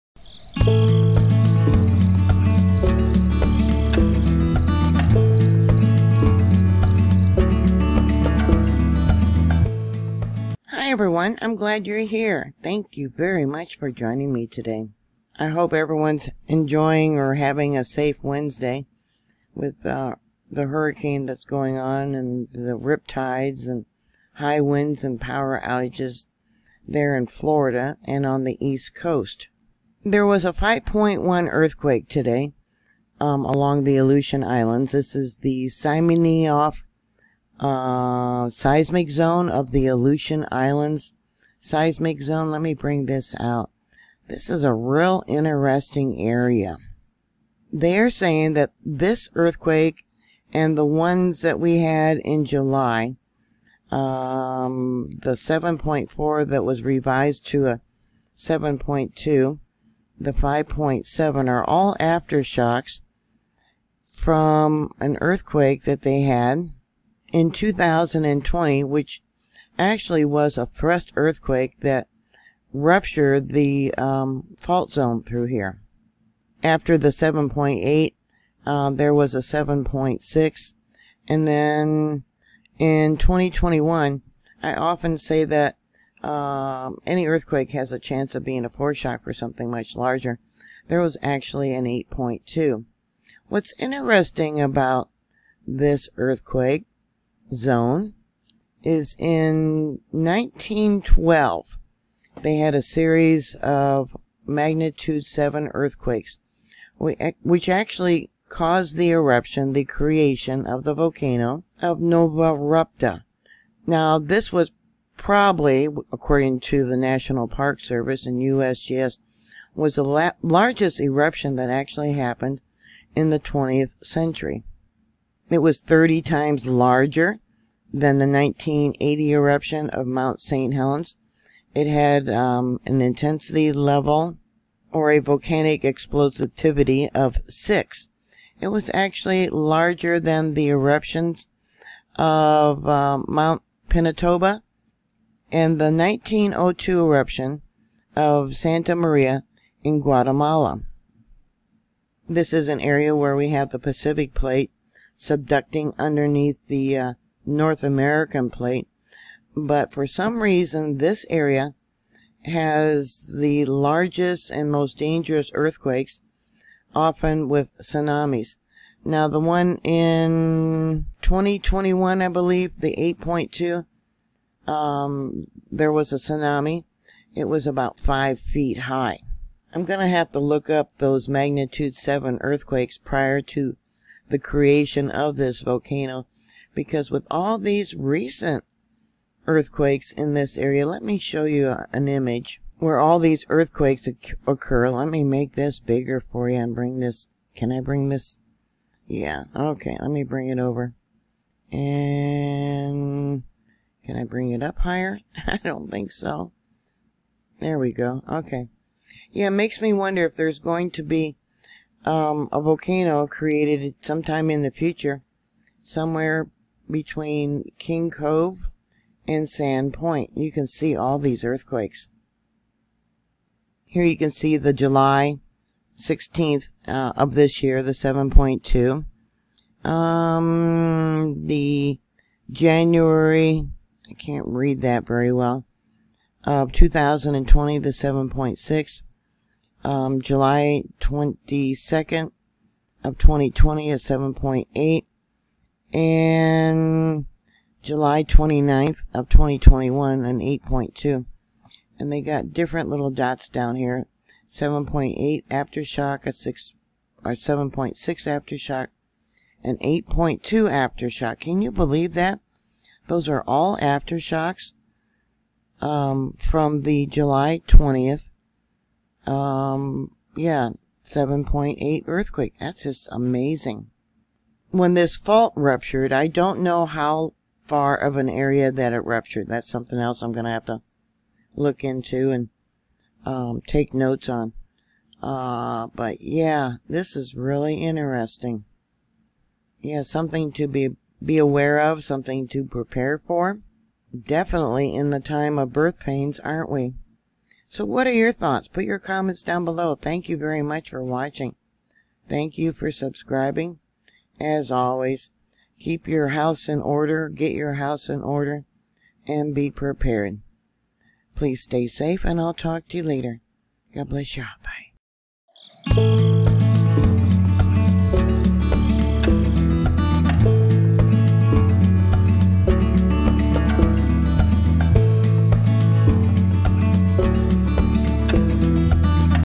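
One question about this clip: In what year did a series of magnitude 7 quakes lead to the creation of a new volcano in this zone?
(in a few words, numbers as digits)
1912.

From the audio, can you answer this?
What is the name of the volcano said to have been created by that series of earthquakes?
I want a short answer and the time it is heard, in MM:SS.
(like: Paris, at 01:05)
Novarupta, at 01:51.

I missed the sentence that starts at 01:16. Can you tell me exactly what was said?
After the 7.8, uh, um, there was a 7.6.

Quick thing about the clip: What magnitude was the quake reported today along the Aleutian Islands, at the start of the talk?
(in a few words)
5.1.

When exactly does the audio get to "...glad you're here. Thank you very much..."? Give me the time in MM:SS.
00:11.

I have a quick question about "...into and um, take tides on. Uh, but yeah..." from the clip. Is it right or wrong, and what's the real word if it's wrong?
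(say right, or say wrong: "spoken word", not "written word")
wrong: "notes", not "tides".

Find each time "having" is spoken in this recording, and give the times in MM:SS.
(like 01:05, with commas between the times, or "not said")
00:17.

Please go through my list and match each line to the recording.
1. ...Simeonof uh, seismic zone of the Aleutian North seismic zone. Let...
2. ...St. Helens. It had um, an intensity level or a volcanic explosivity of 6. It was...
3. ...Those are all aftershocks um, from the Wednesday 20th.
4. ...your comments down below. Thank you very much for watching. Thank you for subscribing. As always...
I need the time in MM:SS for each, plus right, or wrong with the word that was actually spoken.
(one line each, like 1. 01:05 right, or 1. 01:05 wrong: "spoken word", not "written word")
1. 00:35 wrong: "Islands", not "North"
2. 02:10 right
3. 04:23 wrong: "July", not "Wednesday"
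4. 04:58 right.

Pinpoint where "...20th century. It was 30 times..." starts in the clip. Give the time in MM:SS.
02:03.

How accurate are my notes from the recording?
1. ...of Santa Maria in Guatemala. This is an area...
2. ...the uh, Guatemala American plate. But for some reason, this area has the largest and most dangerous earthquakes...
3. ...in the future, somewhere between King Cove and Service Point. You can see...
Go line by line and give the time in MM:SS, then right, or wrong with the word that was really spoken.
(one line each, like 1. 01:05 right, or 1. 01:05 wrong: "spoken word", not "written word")
1. 02:28 right
2. 02:36 wrong: "North", not "Guatemala"
3. 03:34 wrong: "Sand", not "Service".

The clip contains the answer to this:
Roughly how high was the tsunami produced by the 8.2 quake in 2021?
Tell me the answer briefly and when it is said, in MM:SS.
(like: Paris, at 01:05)
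5 feet, at 02:57.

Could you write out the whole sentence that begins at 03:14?
Let me make this bigger for you and bring this.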